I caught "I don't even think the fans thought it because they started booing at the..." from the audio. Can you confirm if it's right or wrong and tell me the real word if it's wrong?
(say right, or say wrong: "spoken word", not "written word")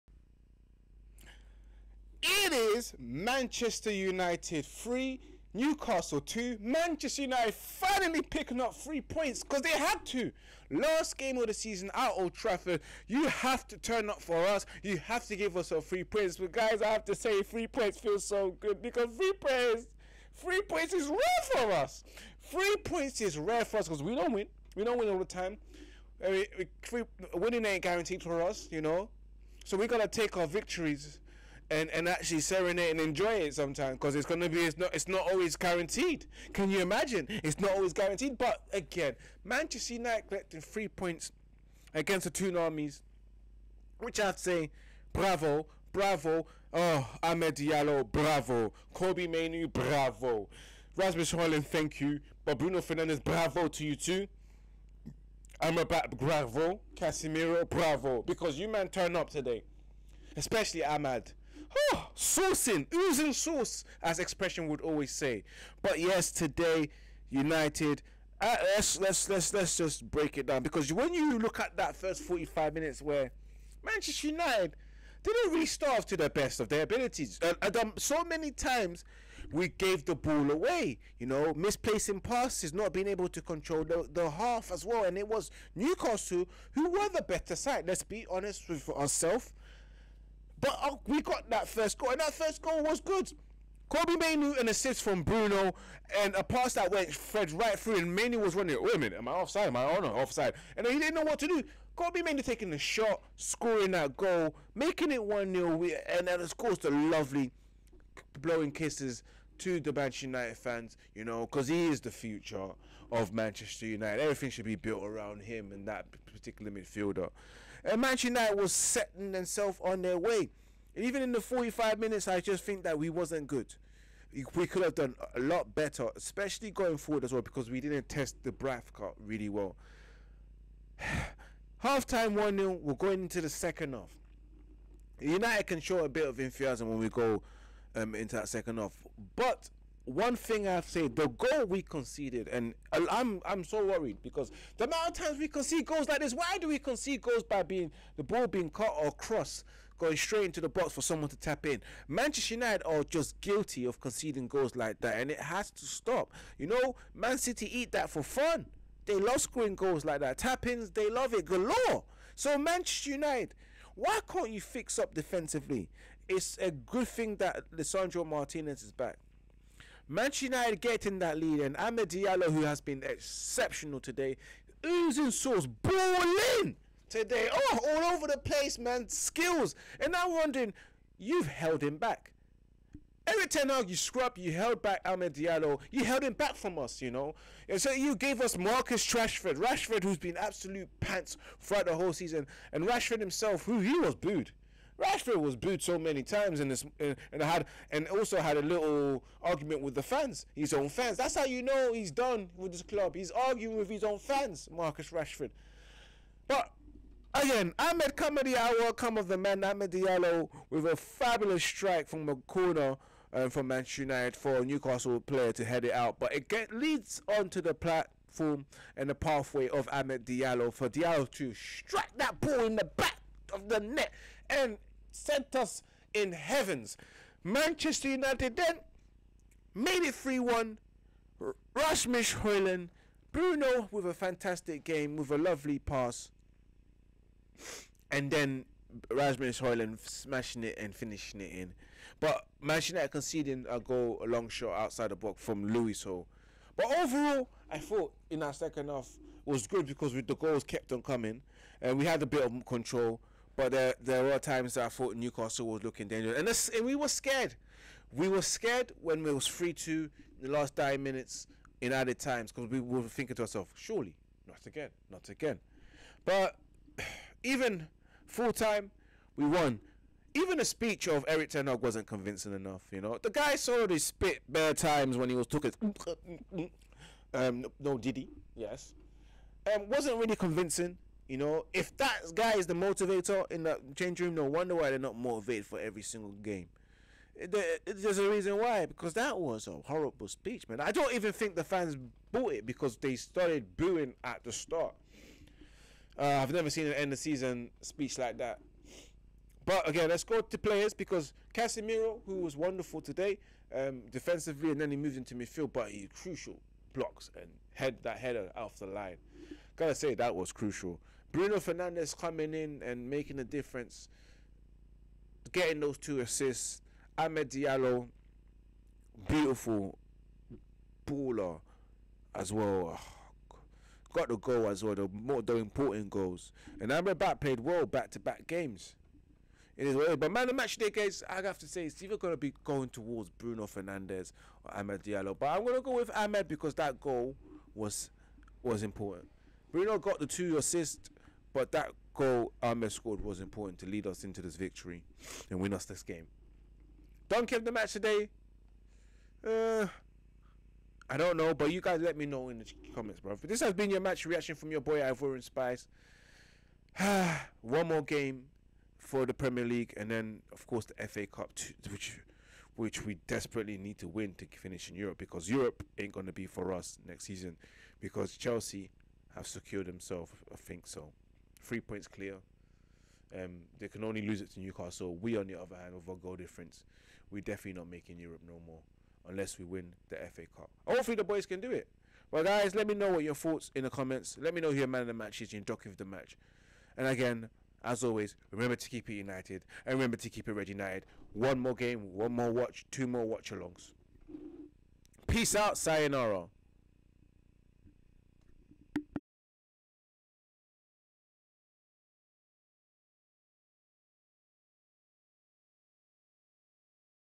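wrong: "bought", not "thought".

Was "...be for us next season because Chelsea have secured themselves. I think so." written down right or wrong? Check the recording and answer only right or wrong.
right.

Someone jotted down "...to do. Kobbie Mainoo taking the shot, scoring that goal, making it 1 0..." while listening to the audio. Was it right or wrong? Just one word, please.
right.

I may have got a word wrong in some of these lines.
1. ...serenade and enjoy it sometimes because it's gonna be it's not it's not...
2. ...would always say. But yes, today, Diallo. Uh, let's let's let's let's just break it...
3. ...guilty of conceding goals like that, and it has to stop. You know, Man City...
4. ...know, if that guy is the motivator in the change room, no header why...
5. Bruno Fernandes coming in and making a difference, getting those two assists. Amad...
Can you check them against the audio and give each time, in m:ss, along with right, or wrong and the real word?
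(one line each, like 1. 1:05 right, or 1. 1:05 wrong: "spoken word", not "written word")
1. 0:32 right
2. 1:04 wrong: "United", not "Diallo"
3. 2:33 right
4. 4:41 wrong: "wonder", not "header"
5. 5:11 right.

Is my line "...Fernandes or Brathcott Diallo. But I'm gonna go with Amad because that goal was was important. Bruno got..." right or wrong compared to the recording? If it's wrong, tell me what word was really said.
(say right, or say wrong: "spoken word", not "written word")
wrong: "Amad", not "Brathcott".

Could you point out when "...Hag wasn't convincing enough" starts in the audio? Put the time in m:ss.
4:31.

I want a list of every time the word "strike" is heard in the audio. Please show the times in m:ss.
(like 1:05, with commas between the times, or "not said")
3:31, 3:41.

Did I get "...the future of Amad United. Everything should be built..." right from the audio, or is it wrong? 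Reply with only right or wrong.
wrong.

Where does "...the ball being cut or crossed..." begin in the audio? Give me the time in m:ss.
2:28.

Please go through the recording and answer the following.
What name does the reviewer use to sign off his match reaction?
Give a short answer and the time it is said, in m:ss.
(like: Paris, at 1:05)
Ivorian Spice, at 5:54.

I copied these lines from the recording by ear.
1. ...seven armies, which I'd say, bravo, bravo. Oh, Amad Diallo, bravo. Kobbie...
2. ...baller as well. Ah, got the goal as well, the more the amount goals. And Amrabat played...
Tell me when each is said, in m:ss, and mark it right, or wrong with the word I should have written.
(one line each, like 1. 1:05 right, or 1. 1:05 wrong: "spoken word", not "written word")
1. 0:42 wrong: "two", not "seven"
2. 5:21 wrong: "important", not "amount".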